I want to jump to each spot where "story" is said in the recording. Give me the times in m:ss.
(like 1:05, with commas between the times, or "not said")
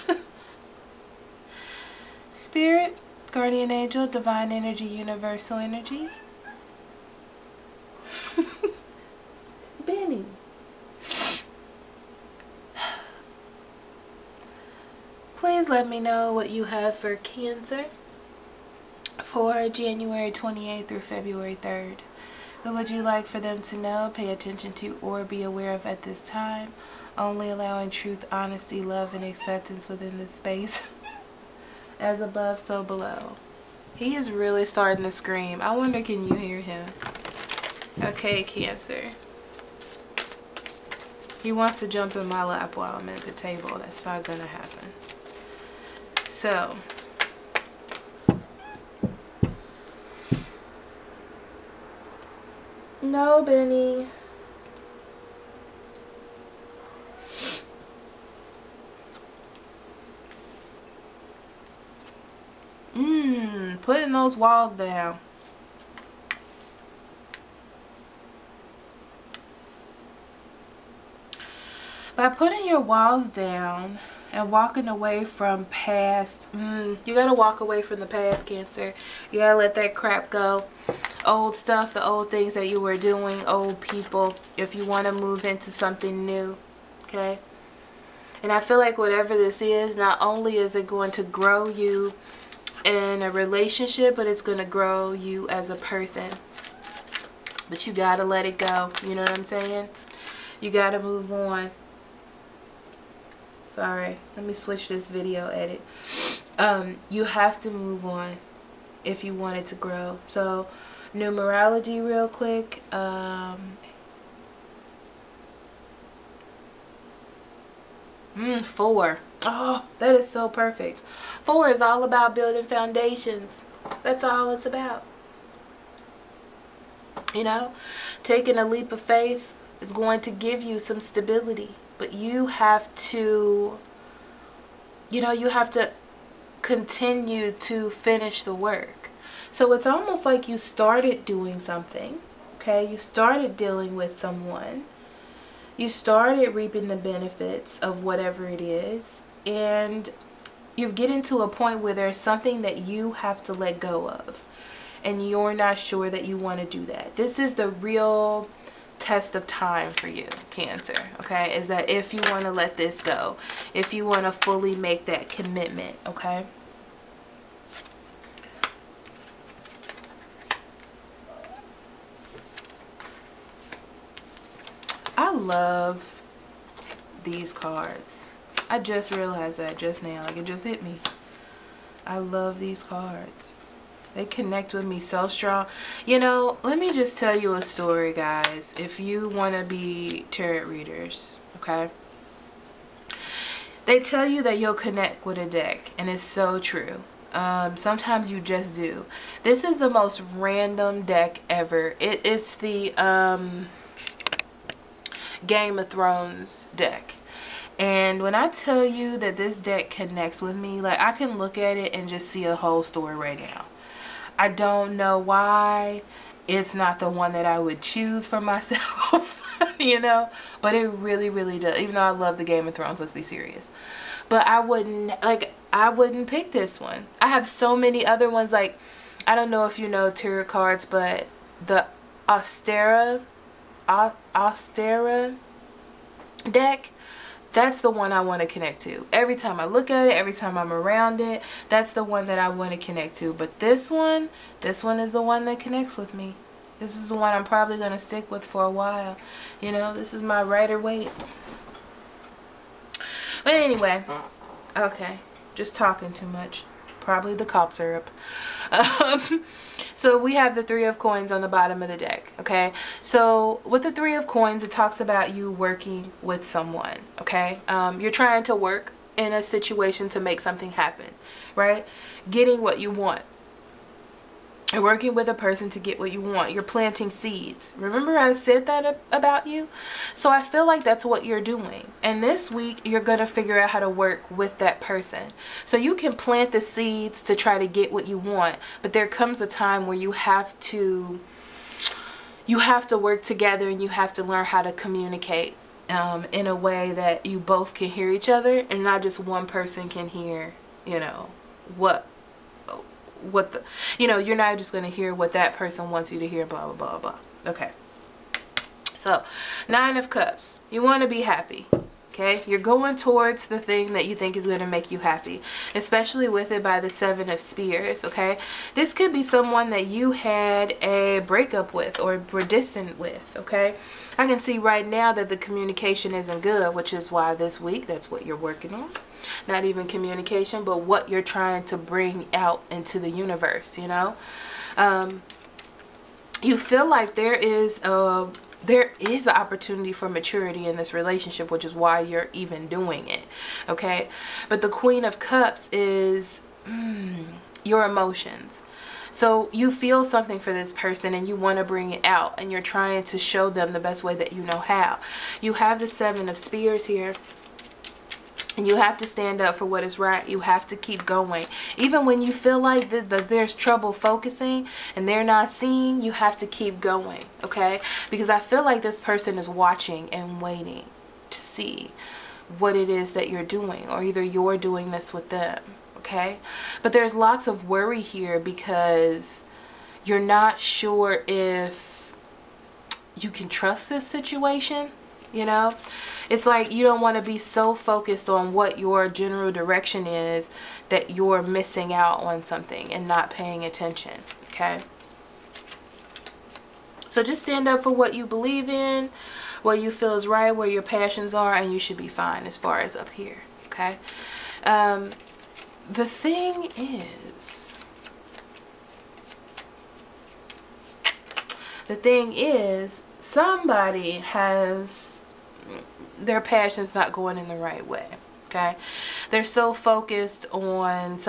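3:07, 3:32.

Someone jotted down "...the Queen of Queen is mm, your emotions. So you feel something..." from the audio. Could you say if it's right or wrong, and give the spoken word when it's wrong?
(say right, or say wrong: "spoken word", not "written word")
wrong: "Cups", not "Queen".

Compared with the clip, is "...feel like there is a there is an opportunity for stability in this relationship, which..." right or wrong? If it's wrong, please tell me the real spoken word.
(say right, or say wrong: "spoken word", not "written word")
wrong: "maturity", not "stability".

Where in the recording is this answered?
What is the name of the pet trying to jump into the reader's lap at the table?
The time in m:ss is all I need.
0:53.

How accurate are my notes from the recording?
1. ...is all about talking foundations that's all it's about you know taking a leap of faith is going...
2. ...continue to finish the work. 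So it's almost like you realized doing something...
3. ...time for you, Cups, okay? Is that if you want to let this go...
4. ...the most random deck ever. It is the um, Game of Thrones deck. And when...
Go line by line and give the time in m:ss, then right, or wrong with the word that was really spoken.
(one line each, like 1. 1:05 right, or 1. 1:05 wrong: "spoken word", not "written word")
1. 2:01 wrong: "building", not "talking"
2. 2:16 wrong: "started", not "realized"
3. 2:39 wrong: "Cancer", not "Cups"
4. 3:19 right.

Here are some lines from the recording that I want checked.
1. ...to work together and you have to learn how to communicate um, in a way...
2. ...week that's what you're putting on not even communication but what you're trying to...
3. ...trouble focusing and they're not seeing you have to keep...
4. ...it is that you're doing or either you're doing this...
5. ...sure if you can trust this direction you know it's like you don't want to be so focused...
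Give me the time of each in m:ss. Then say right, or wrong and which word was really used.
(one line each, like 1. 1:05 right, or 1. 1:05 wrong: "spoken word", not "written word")
1. 4:52 right
2. 5:27 wrong: "working", not "putting"
3. 6:03 right
4. 6:12 right
5. 6:20 wrong: "situation", not "direction".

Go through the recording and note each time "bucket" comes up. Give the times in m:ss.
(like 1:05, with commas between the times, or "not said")
not said.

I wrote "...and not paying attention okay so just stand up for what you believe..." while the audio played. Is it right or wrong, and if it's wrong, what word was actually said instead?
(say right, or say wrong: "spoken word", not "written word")
right.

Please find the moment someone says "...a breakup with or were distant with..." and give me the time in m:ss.
5:20.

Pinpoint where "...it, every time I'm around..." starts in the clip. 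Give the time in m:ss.
4:00.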